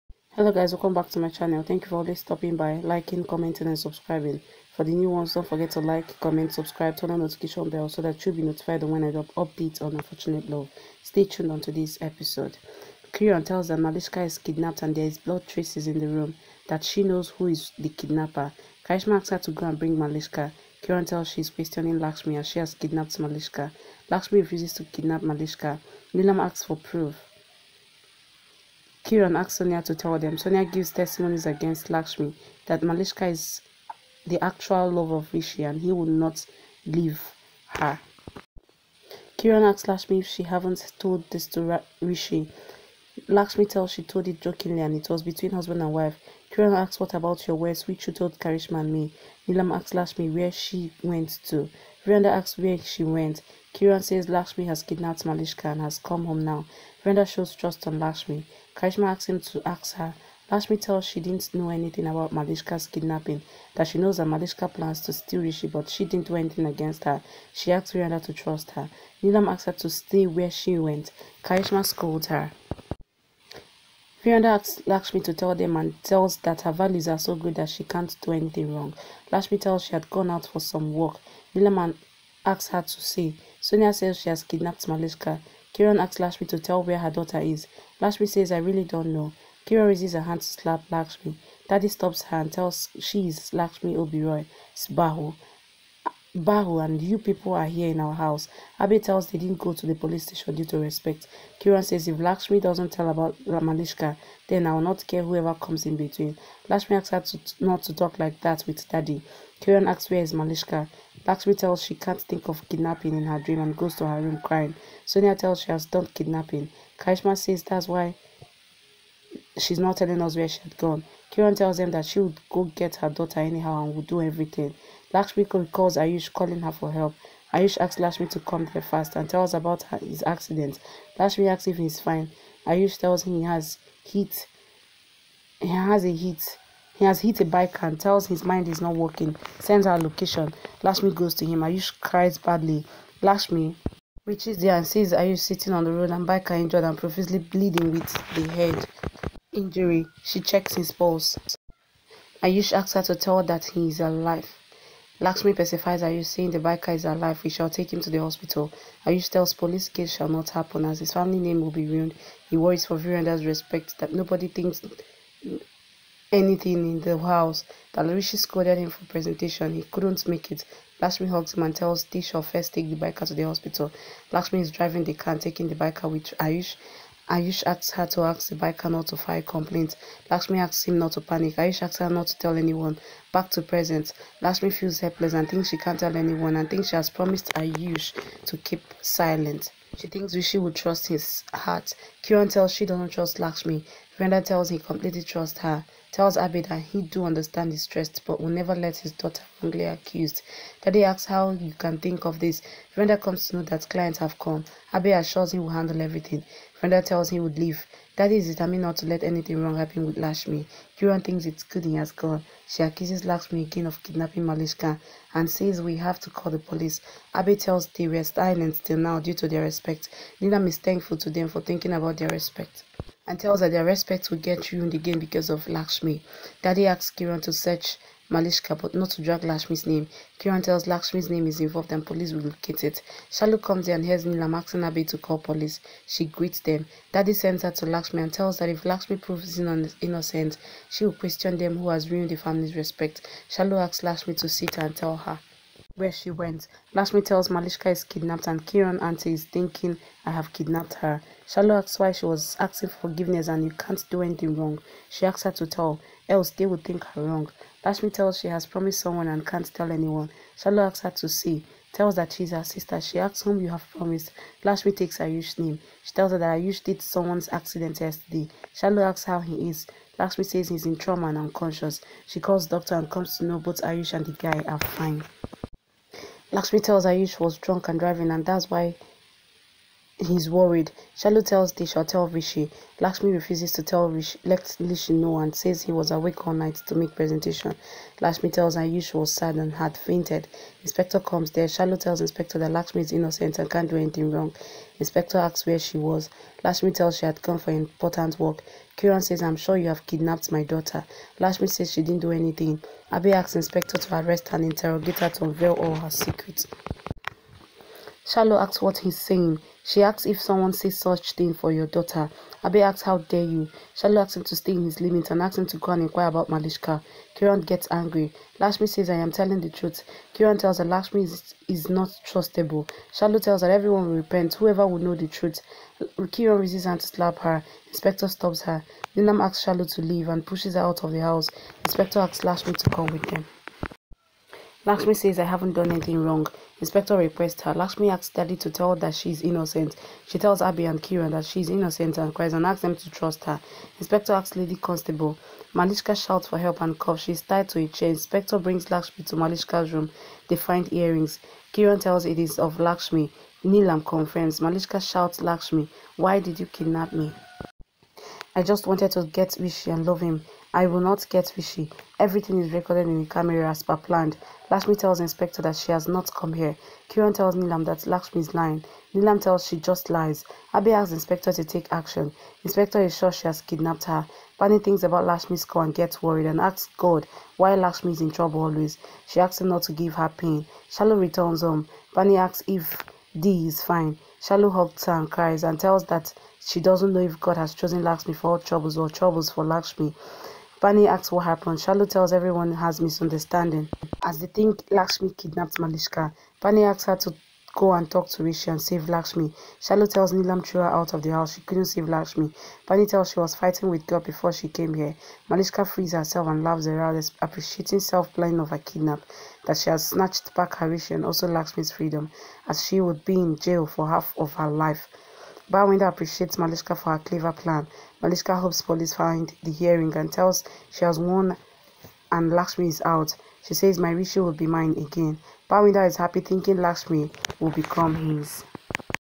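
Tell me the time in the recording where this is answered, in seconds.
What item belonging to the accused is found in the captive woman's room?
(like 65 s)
350 s.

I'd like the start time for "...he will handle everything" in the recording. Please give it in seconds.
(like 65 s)
205 s.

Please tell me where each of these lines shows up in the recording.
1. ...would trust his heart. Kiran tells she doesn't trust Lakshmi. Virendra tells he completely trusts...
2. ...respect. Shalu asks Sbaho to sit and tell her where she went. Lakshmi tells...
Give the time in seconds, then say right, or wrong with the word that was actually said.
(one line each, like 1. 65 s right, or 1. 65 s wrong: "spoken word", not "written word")
1. 190 s right
2. 242 s wrong: "Lakshmi", not "Sbaho".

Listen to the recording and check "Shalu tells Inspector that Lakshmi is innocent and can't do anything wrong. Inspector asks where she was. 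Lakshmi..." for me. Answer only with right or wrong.
right.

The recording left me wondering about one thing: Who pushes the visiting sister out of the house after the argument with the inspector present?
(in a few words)
Dinam.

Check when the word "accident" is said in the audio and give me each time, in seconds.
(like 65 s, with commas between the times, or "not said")
130 s, 267 s.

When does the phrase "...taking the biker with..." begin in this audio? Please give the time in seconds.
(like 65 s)
175 s.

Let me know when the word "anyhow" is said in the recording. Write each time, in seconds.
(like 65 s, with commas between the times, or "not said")
123 s.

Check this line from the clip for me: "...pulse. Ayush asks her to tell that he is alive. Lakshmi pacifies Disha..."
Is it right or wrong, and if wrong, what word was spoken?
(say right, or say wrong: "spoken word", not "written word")
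wrong: "Ayush", not "Disha".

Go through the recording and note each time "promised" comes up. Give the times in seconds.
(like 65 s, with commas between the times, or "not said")
187 s, 258 s, 263 s.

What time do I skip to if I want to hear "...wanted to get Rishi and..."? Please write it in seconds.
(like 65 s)
358 s.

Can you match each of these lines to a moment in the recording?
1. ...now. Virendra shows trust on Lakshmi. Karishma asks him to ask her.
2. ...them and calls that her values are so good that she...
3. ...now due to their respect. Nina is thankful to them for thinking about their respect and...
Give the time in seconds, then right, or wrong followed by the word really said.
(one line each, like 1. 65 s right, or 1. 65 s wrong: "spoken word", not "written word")
1. 56 s right
2. 75 s wrong: "tells", not "calls"
3. 218 s right.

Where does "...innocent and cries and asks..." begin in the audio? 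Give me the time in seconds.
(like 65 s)
341 s.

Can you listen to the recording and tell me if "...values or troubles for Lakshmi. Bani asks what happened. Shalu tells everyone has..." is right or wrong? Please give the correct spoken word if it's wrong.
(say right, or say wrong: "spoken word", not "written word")
wrong: "troubles", not "values".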